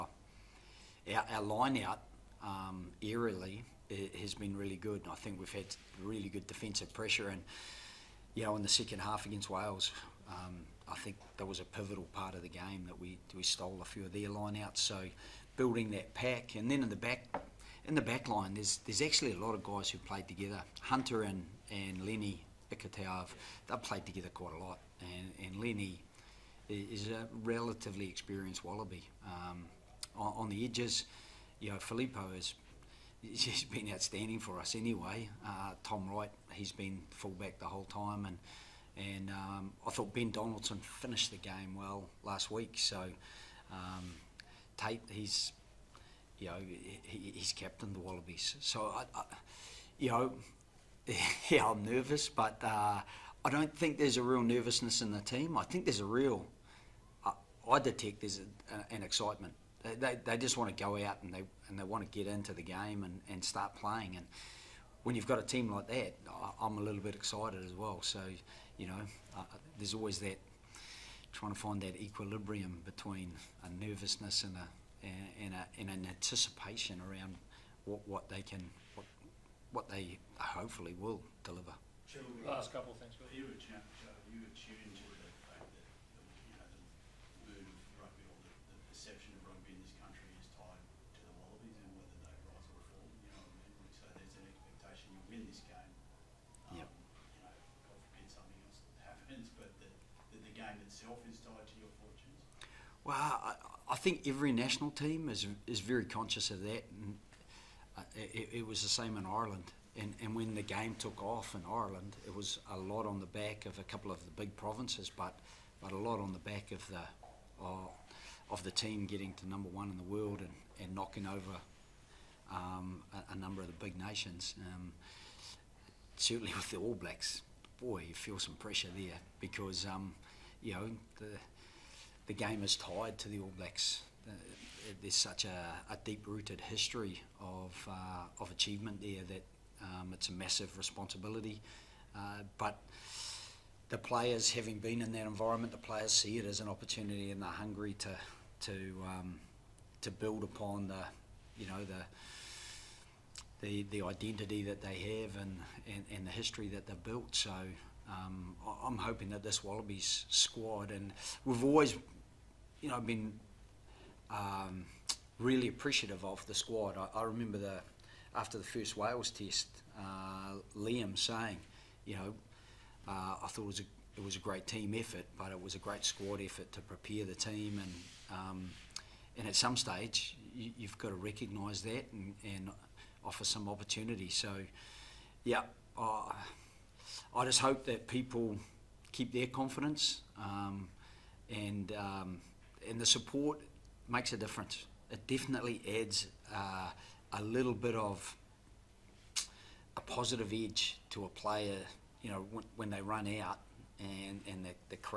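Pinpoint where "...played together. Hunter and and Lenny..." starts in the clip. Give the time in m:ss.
0:19.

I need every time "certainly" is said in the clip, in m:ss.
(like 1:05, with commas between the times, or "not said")
2:06.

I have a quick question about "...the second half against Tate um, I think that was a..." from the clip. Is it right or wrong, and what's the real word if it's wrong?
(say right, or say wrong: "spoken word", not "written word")
wrong: "Wales", not "Tate".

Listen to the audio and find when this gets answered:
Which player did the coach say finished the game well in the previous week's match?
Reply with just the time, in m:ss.
0:40.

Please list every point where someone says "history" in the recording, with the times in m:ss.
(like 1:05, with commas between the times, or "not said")
2:16, 2:36.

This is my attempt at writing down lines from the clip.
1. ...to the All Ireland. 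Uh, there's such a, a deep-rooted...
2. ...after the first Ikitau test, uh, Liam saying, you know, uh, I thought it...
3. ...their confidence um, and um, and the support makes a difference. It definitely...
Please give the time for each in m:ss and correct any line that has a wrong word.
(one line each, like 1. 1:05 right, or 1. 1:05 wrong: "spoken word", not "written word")
1. 2:13 wrong: "Blacks", not "Ireland"
2. 2:48 wrong: "Wales", not "Ikitau"
3. 3:09 right.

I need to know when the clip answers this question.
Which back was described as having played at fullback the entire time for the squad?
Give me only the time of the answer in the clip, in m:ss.
0:35.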